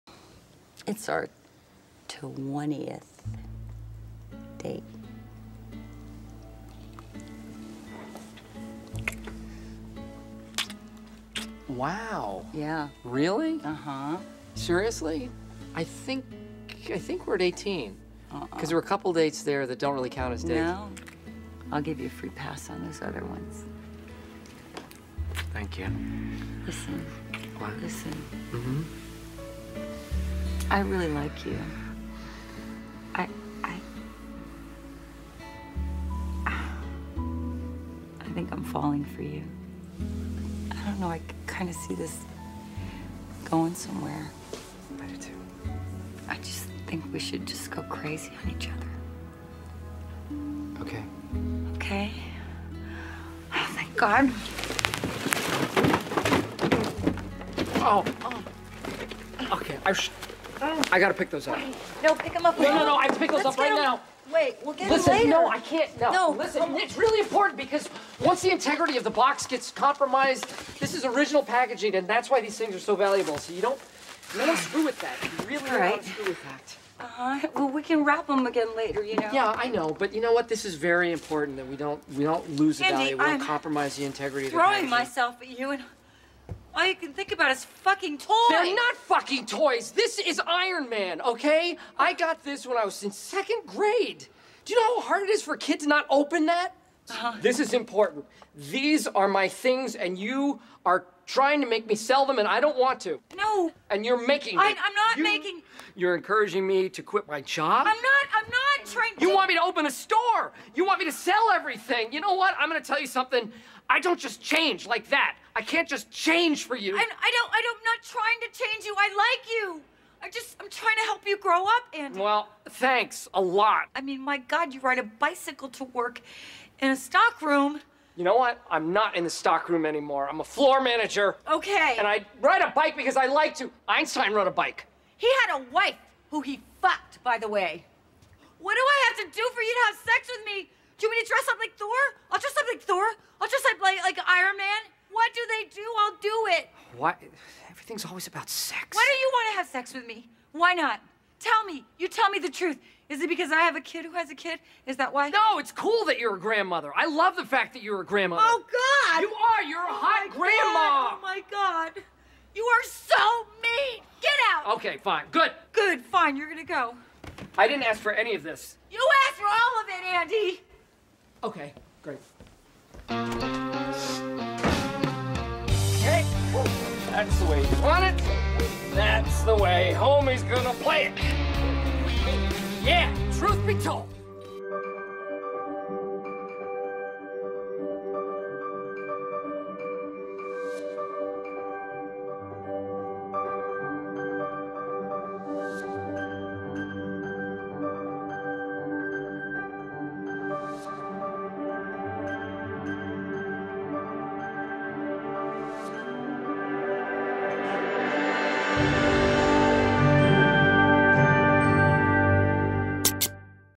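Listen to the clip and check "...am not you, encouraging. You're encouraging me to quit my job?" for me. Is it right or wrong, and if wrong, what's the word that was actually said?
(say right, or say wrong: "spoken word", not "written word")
wrong: "making", not "encouraging".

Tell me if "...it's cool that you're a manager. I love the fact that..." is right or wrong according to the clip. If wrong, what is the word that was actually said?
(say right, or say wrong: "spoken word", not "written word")
wrong: "grandmother", not "manager".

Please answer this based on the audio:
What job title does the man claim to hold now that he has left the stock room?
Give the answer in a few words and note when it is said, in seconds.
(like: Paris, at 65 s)
Floor manager, at 130 s.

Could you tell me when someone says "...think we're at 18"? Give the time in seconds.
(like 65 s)
16 s.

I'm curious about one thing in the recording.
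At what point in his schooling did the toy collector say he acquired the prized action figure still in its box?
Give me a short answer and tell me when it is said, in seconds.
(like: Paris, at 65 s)
Second grade, at 93 s.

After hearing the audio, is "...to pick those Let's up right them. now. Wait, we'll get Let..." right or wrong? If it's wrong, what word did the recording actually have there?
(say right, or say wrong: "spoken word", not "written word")
wrong: "Listen", not "Let".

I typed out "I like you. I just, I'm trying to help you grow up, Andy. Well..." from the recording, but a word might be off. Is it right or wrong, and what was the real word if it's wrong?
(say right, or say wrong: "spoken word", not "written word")
right.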